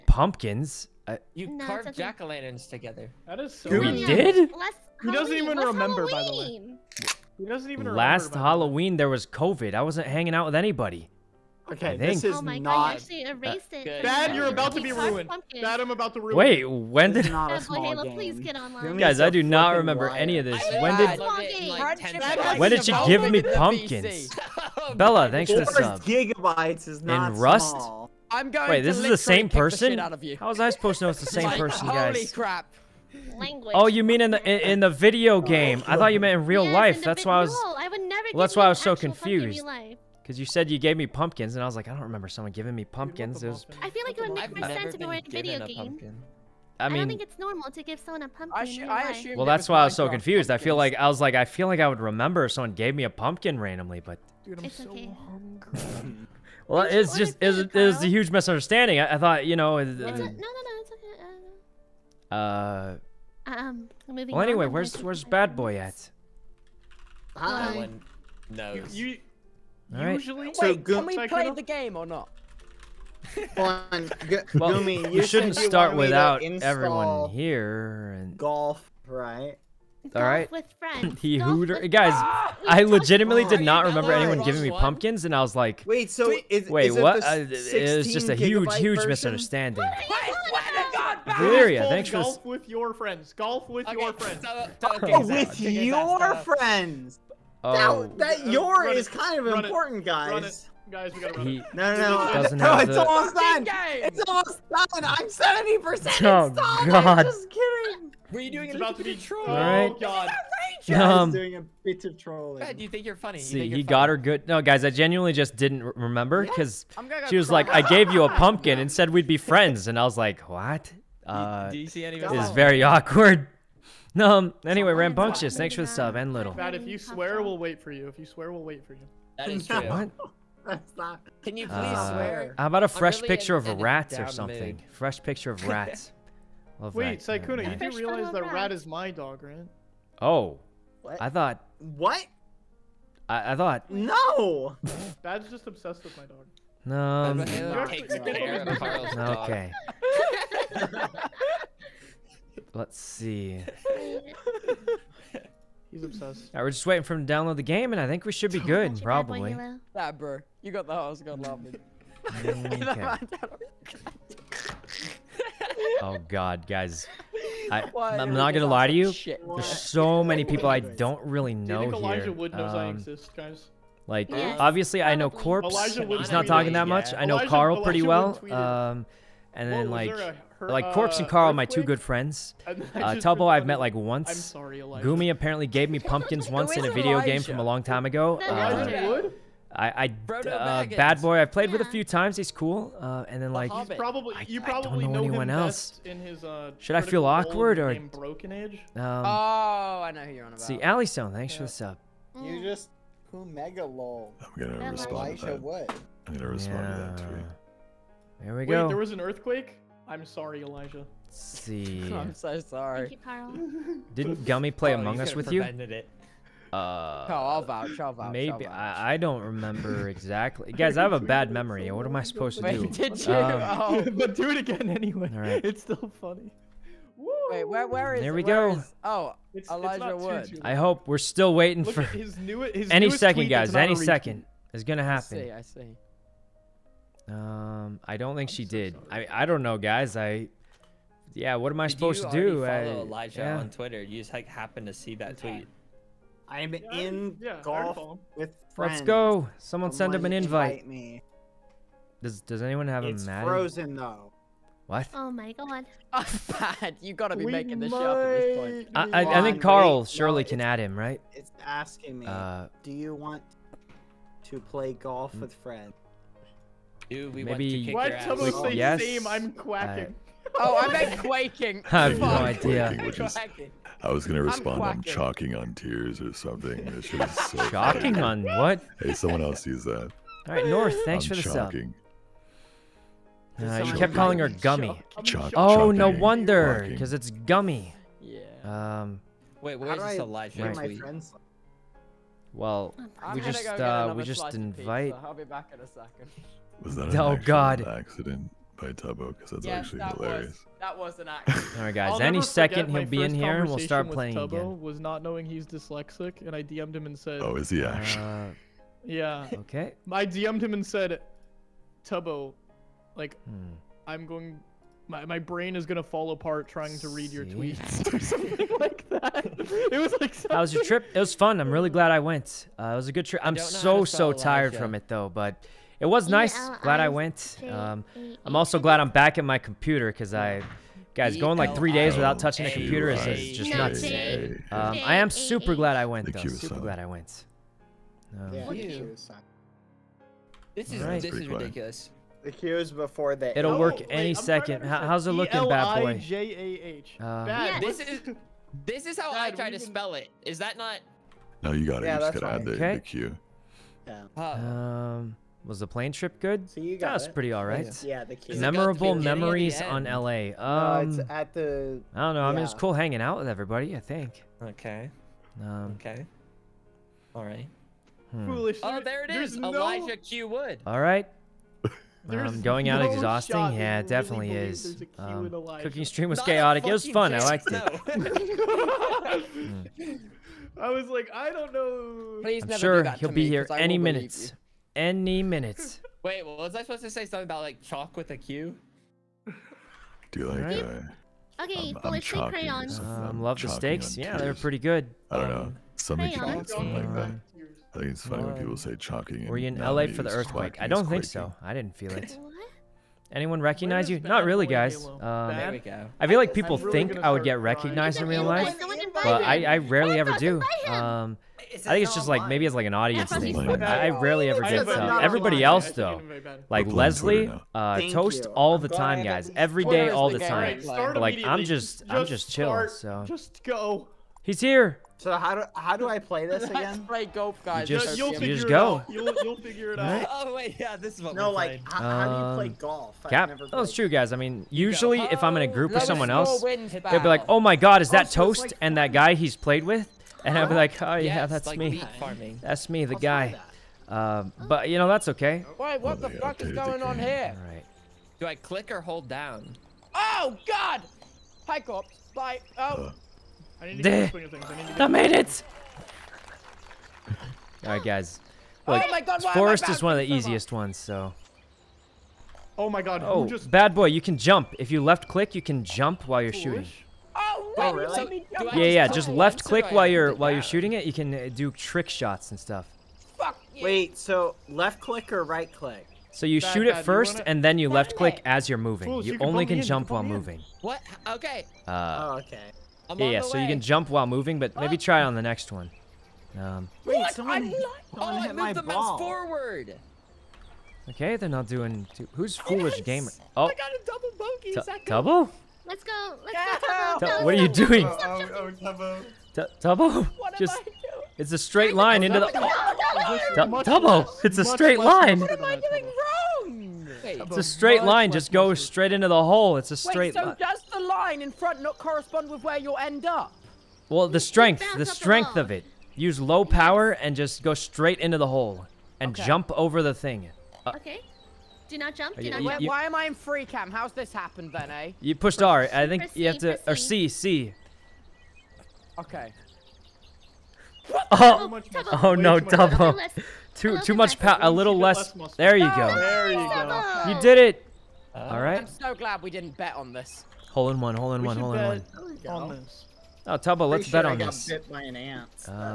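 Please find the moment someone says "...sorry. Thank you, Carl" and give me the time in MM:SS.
03:32.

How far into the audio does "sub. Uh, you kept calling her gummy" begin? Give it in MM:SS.
04:43.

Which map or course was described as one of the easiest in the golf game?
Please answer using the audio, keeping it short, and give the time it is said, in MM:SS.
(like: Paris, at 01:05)
forest, at 07:39.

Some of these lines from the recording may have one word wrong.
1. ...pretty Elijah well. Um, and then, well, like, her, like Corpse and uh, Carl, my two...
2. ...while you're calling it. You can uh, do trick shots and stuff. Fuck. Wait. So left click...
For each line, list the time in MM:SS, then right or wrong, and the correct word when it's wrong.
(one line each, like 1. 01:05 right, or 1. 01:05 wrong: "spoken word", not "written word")
1. 02:57 right
2. 07:50 wrong: "shooting", not "calling".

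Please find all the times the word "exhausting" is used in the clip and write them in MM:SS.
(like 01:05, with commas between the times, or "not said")
06:13.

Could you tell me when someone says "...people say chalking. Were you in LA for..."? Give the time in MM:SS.
06:38.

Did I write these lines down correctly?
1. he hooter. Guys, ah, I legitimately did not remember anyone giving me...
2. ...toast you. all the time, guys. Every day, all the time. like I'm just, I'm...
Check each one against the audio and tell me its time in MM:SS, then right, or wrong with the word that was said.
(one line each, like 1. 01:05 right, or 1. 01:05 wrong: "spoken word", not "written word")
1. 01:21 right
2. 06:58 right.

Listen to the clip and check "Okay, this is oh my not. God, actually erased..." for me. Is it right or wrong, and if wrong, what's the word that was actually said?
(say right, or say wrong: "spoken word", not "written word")
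right.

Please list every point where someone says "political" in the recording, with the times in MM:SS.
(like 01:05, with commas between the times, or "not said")
not said.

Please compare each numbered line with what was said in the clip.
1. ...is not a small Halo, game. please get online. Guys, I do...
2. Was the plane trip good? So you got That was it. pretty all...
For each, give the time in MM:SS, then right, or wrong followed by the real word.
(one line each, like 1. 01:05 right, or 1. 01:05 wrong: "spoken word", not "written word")
1. 00:17 right
2. 05:55 right.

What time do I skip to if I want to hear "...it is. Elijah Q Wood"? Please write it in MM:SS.
06:09.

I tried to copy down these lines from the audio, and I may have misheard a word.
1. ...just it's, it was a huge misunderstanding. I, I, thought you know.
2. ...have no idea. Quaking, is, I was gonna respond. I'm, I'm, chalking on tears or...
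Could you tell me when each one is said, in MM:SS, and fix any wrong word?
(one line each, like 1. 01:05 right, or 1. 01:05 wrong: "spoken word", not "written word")
1. 00:57 right
2. 04:31 right.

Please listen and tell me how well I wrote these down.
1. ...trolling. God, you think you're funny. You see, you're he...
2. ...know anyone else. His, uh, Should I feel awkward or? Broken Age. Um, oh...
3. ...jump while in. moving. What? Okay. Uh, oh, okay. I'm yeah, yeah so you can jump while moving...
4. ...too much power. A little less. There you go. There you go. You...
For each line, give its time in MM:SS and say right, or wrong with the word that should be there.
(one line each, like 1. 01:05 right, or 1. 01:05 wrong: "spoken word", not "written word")
1. 01:52 right
2. 03:15 right
3. 07:59 right
4. 08:53 right.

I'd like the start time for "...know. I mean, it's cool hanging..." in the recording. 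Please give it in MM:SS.
06:02.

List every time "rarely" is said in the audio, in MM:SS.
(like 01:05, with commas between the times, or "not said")
06:49, 06:54.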